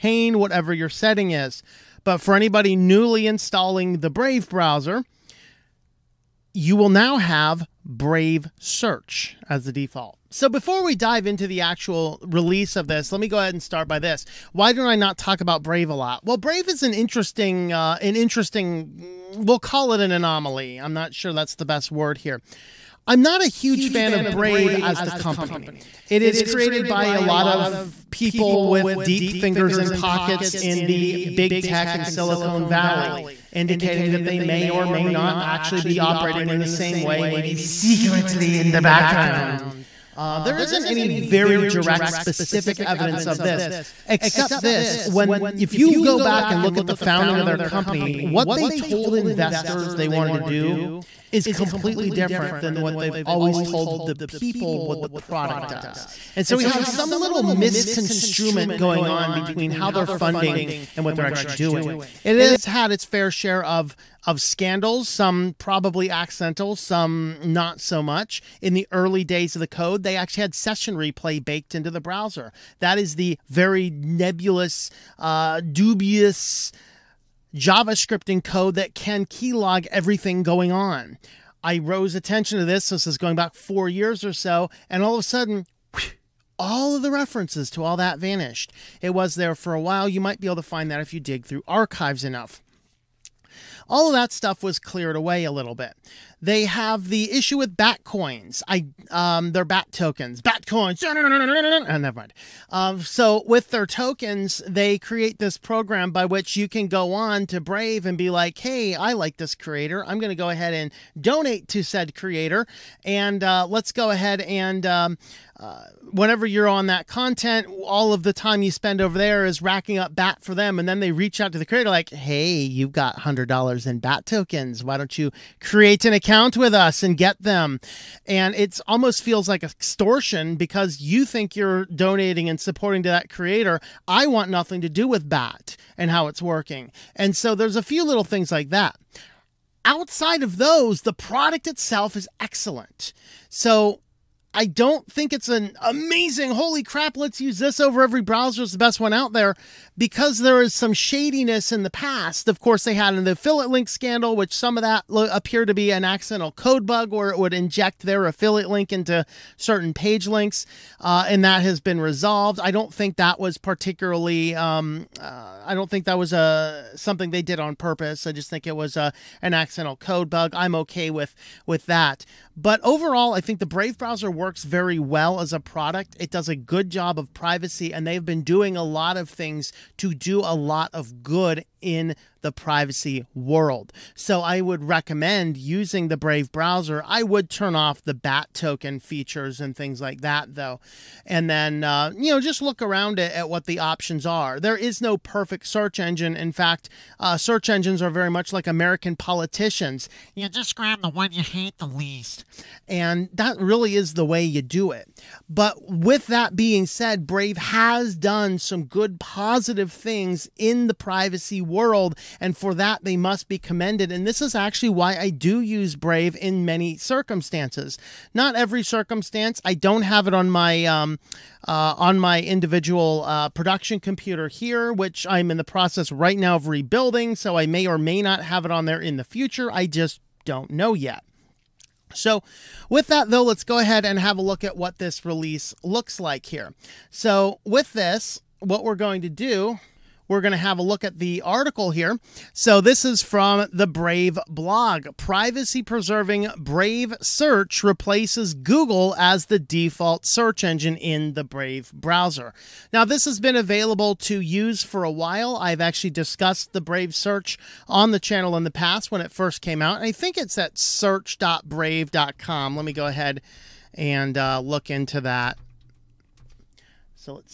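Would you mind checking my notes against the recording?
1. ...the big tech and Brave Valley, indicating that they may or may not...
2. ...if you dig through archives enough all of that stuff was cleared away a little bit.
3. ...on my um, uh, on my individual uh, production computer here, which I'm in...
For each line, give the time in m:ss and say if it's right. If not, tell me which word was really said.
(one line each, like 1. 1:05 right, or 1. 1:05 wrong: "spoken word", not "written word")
1. 0:30 wrong: "Silicon", not "Brave"
2. 1:30 right
3. 3:40 right.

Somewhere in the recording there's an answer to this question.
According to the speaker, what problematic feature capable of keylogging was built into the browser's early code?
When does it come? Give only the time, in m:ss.
1:10.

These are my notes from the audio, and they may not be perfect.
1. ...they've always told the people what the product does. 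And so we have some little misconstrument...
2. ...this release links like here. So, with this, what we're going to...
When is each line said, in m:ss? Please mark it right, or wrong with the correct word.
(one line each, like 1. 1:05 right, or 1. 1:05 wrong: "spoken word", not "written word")
1. 0:52 right
2. 3:54 wrong: "looks", not "links".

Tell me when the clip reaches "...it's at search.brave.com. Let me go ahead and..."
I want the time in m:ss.
4:20.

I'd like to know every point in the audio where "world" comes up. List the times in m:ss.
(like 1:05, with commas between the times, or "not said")
3:03, 3:31.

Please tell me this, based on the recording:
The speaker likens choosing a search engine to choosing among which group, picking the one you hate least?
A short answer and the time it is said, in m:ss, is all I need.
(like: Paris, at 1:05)
American politicians, at 3:18.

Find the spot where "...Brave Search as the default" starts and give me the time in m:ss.
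0:07.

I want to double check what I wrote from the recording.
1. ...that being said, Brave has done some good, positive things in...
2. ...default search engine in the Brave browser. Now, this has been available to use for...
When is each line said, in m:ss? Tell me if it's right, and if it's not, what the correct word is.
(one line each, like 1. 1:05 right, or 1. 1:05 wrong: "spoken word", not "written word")
1. 3:26 right
2. 4:09 right.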